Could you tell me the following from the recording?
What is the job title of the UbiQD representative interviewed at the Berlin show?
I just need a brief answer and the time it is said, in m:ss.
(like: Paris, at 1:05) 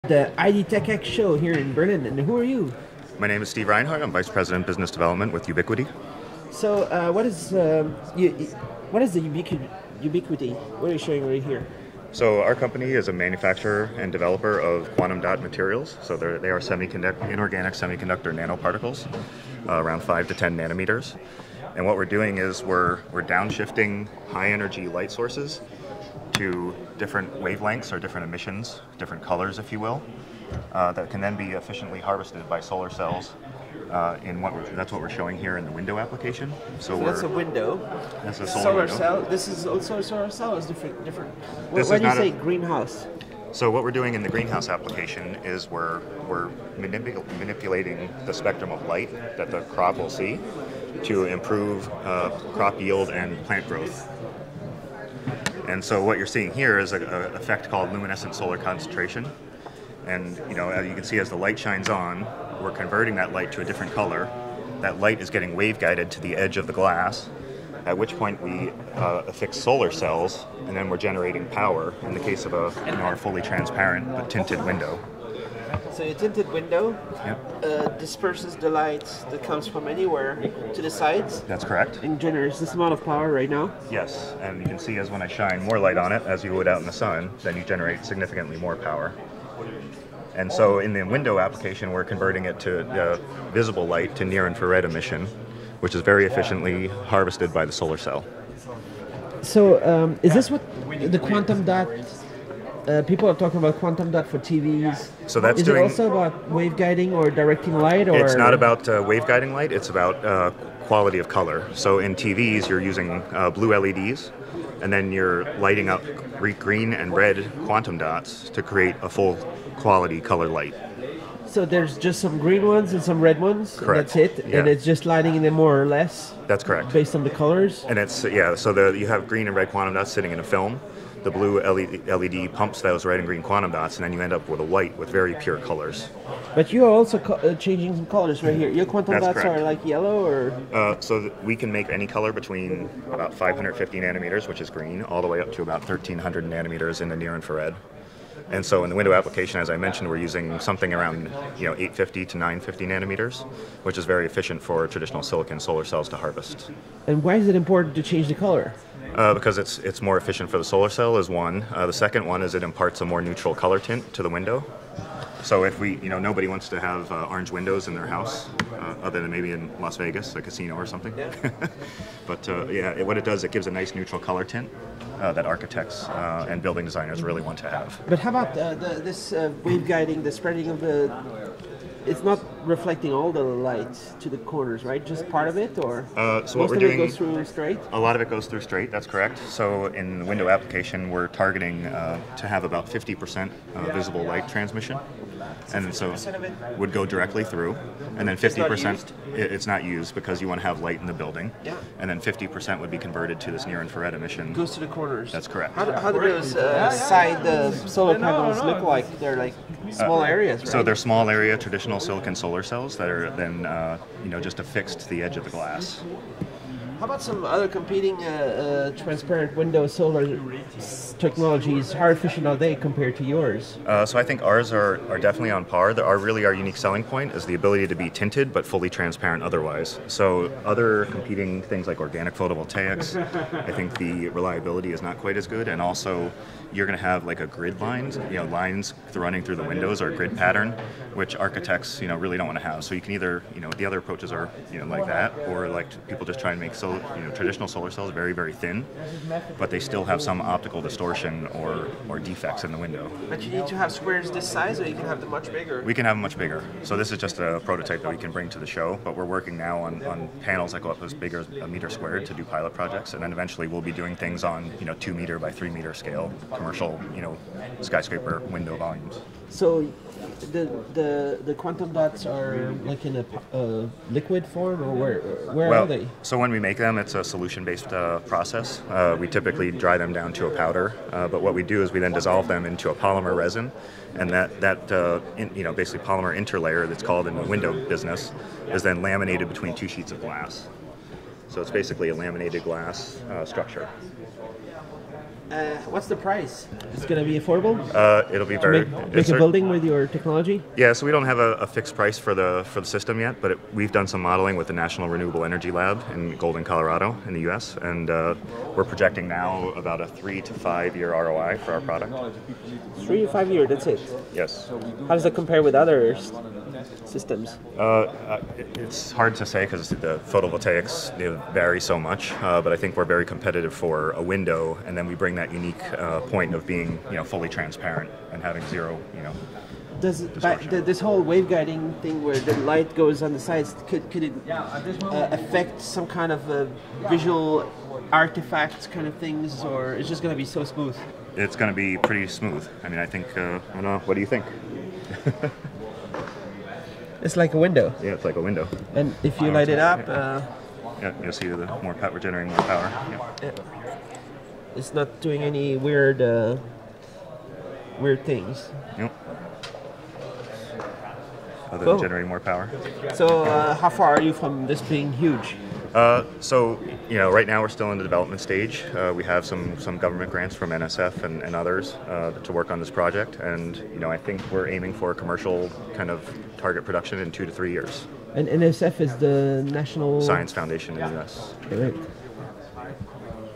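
Vice President Business Development, at 0:04.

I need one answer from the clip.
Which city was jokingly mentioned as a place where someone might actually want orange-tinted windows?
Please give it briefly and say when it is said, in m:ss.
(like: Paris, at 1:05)
Las Vegas, at 2:49.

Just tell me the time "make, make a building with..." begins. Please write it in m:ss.
4:58.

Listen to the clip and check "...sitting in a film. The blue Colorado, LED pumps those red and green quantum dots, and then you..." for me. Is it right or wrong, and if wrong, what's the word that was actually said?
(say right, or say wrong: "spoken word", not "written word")
wrong: "LED", not "Colorado".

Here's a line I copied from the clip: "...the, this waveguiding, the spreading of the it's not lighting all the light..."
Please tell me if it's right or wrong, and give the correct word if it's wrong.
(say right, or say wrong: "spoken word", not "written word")
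wrong: "reflecting", not "lighting".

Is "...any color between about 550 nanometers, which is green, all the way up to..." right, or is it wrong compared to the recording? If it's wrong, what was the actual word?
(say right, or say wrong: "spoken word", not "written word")
right.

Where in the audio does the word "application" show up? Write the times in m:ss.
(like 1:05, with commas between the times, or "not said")
0:35, 0:44, 1:31, 2:29, 3:10.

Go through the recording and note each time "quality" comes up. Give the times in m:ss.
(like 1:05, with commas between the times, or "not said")
1:50, 1:59.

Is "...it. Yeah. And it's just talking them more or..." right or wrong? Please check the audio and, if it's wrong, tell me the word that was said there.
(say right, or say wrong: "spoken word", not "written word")
wrong: "lighting", not "talking".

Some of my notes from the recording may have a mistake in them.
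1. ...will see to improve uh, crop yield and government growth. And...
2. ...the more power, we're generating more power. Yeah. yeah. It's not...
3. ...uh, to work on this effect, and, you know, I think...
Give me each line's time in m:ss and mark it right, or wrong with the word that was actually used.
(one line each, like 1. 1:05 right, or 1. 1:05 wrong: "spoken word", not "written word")
1. 0:49 wrong: "plant", not "government"
2. 5:51 right
3. 6:12 wrong: "project", not "effect".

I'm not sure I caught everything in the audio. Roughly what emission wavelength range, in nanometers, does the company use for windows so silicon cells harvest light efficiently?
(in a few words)
850 to 950 nanometers.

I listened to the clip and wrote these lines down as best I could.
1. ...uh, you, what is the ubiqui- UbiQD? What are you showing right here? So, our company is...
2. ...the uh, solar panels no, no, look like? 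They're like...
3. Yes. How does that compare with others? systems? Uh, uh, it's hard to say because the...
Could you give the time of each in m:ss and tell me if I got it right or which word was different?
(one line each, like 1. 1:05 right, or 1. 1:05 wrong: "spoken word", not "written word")
1. 0:07 right
2. 3:27 right
3. 5:14 right.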